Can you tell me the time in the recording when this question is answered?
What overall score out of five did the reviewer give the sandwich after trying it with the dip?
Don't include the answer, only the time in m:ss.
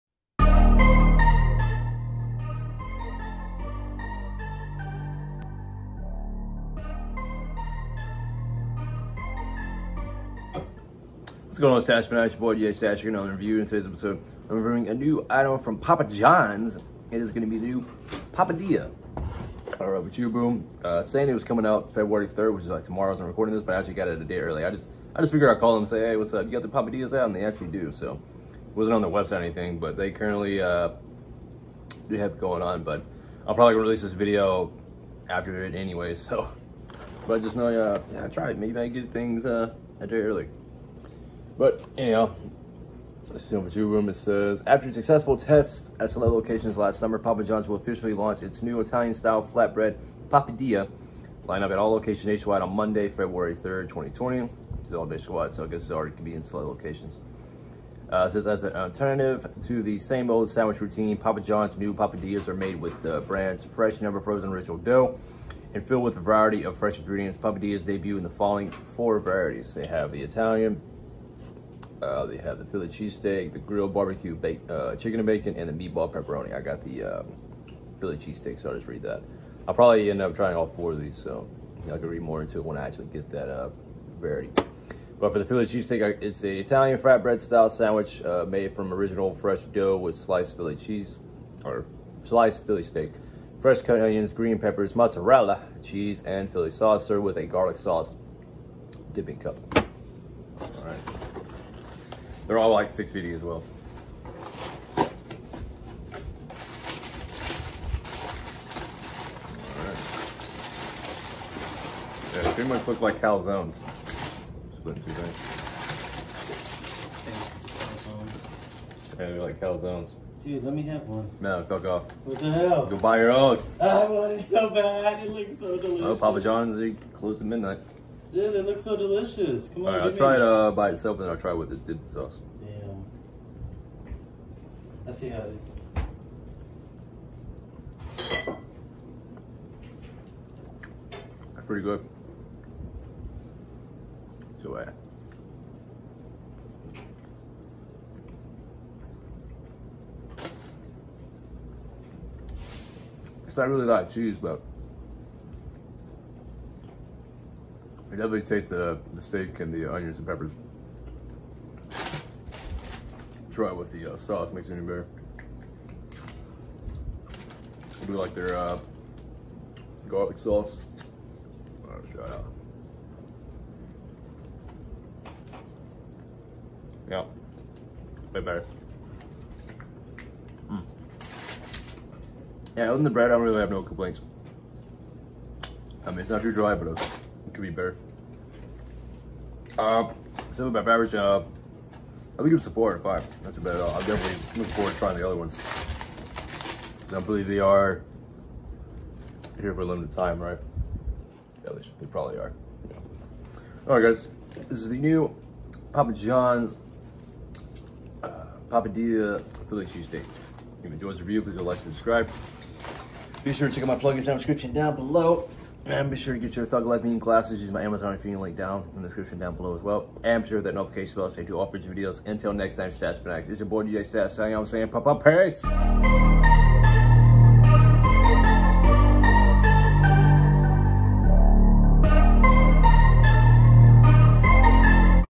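3:12.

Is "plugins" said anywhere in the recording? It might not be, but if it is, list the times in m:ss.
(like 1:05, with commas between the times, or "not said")
3:33.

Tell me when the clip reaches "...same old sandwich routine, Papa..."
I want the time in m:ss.
0:59.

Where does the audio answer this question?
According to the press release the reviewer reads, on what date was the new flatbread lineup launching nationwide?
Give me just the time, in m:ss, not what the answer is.
0:53.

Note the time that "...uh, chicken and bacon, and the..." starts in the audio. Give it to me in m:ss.
1:14.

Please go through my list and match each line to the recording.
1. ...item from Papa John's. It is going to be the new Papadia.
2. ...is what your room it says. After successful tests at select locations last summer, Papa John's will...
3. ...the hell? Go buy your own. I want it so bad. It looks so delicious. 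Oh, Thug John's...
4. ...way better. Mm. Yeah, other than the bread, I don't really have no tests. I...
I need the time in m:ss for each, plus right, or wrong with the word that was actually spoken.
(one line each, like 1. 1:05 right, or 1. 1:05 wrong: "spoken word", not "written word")
1. 0:15 right
2. 0:43 right
3. 2:02 wrong: "Papa", not "Thug"
4. 2:58 wrong: "complaints", not "tests".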